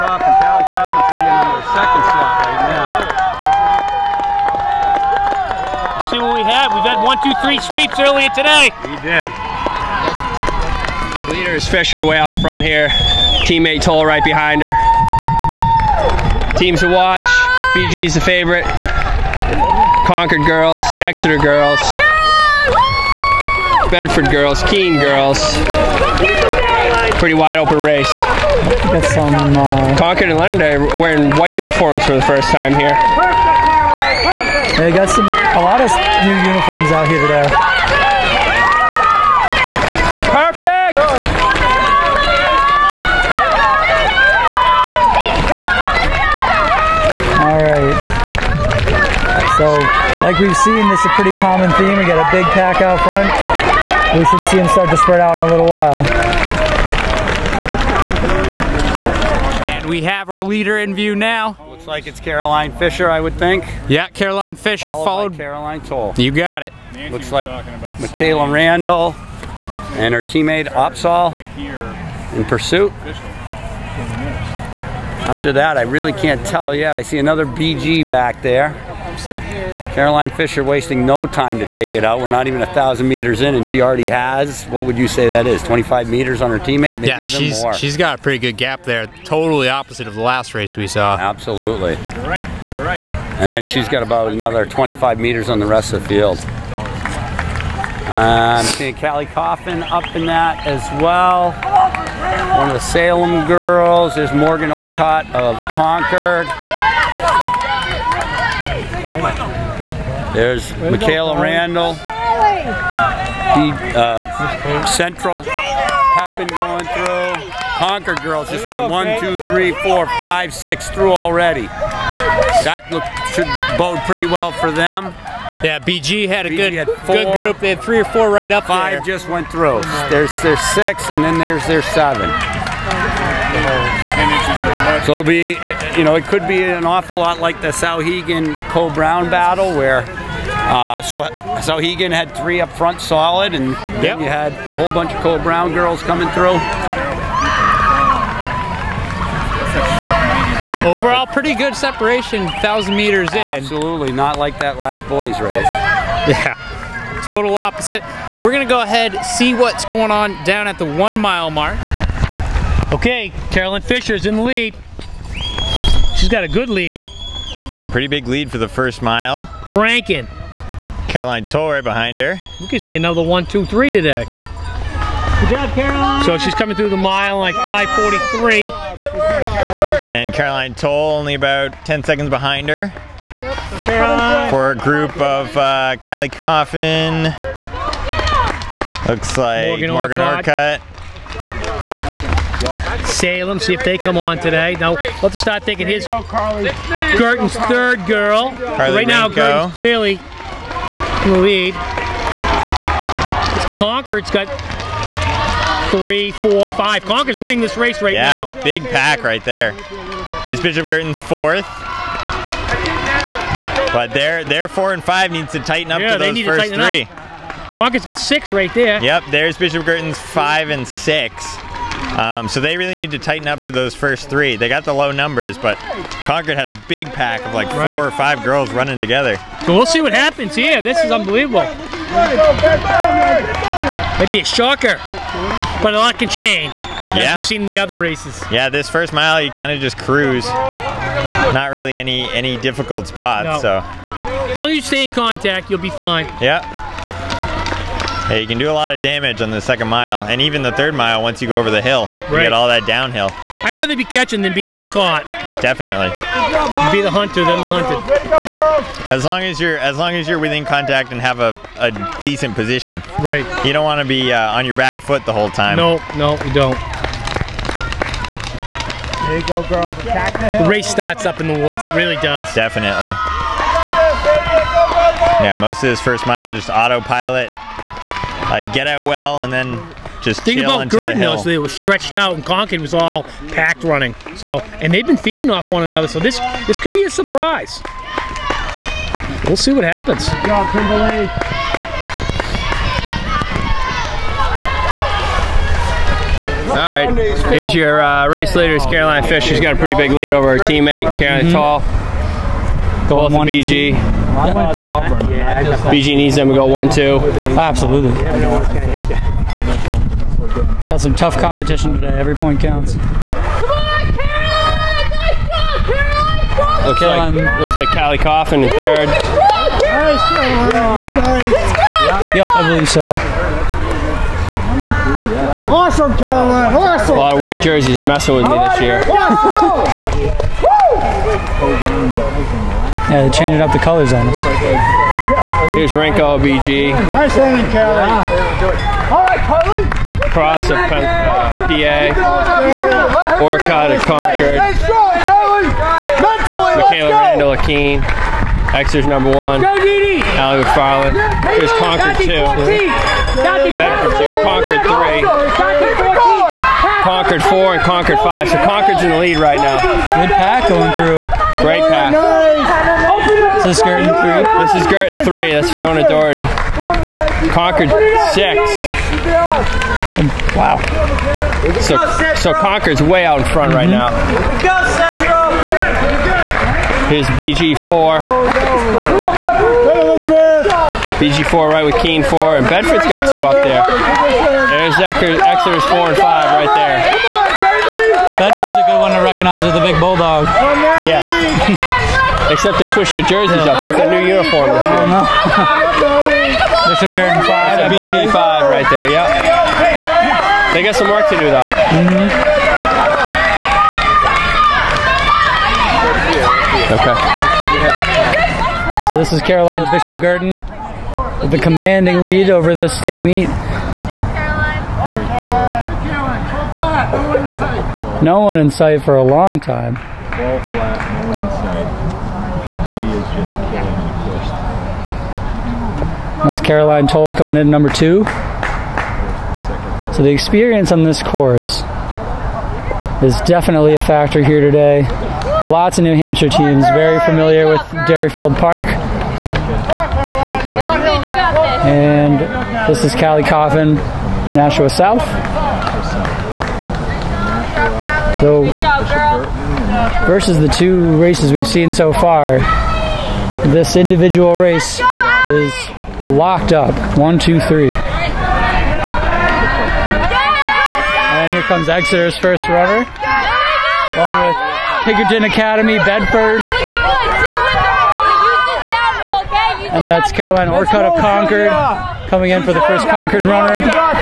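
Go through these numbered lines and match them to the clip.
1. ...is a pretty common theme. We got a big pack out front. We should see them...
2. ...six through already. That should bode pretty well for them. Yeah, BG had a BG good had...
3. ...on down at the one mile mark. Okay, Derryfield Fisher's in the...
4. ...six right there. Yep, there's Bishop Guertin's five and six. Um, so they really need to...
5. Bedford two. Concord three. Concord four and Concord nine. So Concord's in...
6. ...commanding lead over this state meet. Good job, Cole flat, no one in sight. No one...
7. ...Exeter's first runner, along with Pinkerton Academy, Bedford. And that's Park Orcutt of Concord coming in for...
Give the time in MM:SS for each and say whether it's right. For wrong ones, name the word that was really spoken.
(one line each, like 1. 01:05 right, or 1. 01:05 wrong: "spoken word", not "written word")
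1. 00:50 right
2. 02:00 right
3. 02:40 wrong: "Carolyn", not "Derryfield"
4. 03:38 right
5. 05:53 wrong: "five", not "nine"
6. 06:51 wrong: "Caroline", not "Cole"
7. 07:41 wrong: "Caroline", not "Park".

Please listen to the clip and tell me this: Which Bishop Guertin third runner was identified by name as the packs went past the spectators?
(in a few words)
Fiona Doherty.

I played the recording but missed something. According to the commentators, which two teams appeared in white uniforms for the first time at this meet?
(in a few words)
Concord and Leonard.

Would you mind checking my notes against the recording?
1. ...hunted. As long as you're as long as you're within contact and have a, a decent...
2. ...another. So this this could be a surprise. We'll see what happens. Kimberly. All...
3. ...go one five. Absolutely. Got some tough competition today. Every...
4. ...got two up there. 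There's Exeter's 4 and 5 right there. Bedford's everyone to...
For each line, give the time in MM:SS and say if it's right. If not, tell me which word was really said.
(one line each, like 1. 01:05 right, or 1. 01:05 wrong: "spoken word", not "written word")
1. 04:17 right
2. 04:45 right
3. 05:06 wrong: "two", not "five"
4. 06:23 right.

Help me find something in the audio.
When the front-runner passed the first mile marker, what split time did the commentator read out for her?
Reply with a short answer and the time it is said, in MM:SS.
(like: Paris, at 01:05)
5:43, at 02:57.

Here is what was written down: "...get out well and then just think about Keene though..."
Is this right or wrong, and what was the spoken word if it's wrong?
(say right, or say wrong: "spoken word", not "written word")
wrong: "Guertin", not "Keene".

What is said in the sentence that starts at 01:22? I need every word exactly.
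We're not even a thousand meters in, and she already has.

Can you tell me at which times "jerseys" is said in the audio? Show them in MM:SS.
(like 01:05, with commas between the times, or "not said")
05:27, 06:33.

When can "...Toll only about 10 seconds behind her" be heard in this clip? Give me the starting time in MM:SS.
03:00.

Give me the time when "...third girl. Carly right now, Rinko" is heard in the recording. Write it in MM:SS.
03:17.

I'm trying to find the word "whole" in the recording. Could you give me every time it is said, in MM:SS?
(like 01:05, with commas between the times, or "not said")
02:24, 04:25.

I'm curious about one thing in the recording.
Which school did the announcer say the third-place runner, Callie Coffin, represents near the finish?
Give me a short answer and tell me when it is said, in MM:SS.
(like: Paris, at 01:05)
Nashua South, at 07:24.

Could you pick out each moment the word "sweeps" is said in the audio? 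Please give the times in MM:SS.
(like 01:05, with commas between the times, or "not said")
00:07.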